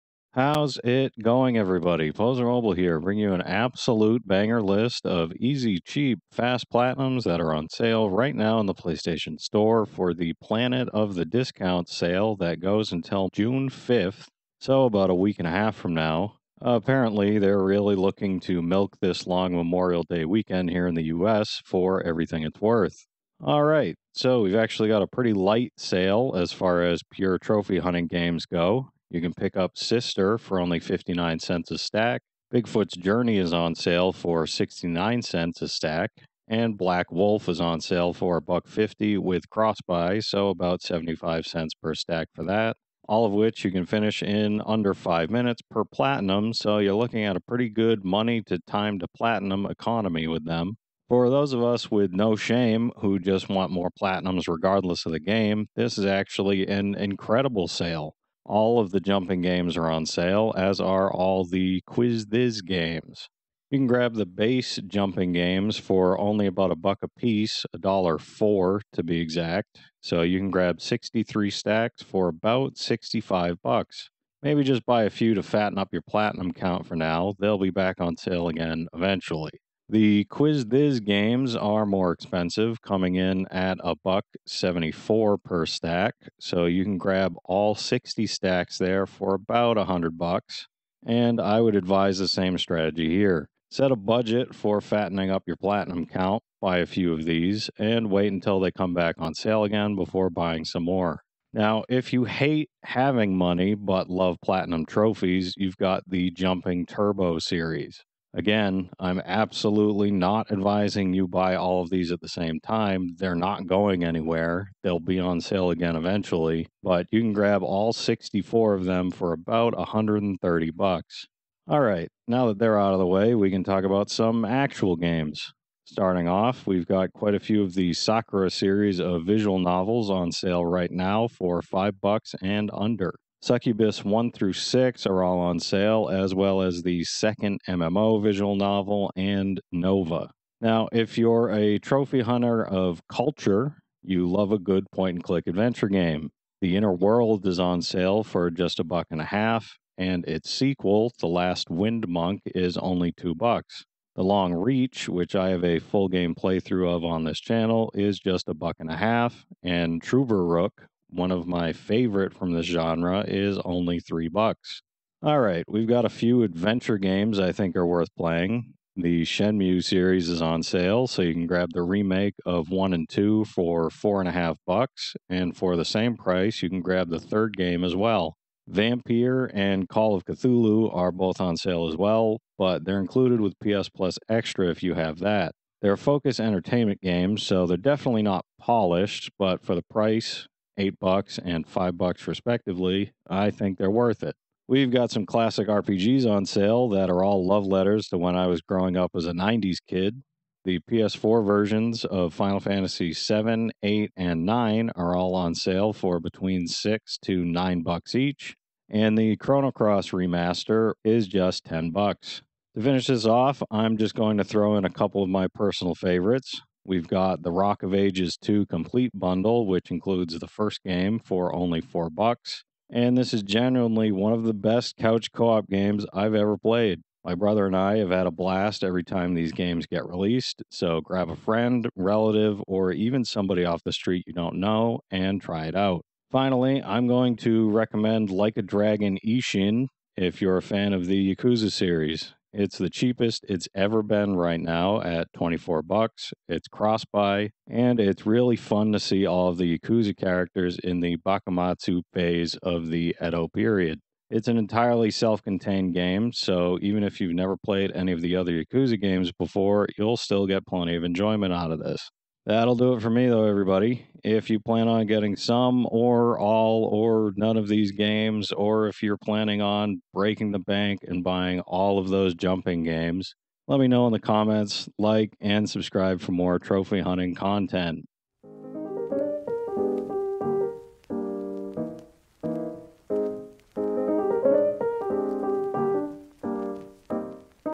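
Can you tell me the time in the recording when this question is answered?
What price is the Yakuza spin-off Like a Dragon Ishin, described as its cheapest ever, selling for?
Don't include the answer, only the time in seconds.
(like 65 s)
245 s.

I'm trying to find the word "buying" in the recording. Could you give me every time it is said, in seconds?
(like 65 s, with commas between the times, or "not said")
100 s, 271 s.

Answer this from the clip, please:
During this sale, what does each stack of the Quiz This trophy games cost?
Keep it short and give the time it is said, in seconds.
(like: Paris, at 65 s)
$1.74, at 83 s.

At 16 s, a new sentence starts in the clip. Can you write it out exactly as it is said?
Apparently, they're really looking to milk this long Memorial Day weekend here in the US for everything it's worth.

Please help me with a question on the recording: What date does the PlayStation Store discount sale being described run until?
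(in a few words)
June 5th.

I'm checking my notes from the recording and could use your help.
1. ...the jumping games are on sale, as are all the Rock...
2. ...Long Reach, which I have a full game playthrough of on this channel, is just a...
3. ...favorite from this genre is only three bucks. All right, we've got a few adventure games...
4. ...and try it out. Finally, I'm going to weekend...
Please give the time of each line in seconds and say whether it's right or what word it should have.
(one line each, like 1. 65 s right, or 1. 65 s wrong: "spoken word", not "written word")
1. 58 s wrong: "Quiz", not "Rock"
2. 154 s right
3. 161 s right
4. 235 s wrong: "recommend", not "weekend".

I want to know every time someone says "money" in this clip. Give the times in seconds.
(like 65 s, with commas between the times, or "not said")
48 s, 103 s.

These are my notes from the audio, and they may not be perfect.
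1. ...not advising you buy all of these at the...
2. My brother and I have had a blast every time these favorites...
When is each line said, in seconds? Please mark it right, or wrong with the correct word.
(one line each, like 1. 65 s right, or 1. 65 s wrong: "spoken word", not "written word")
1. 110 s right
2. 227 s wrong: "games", not "favorites".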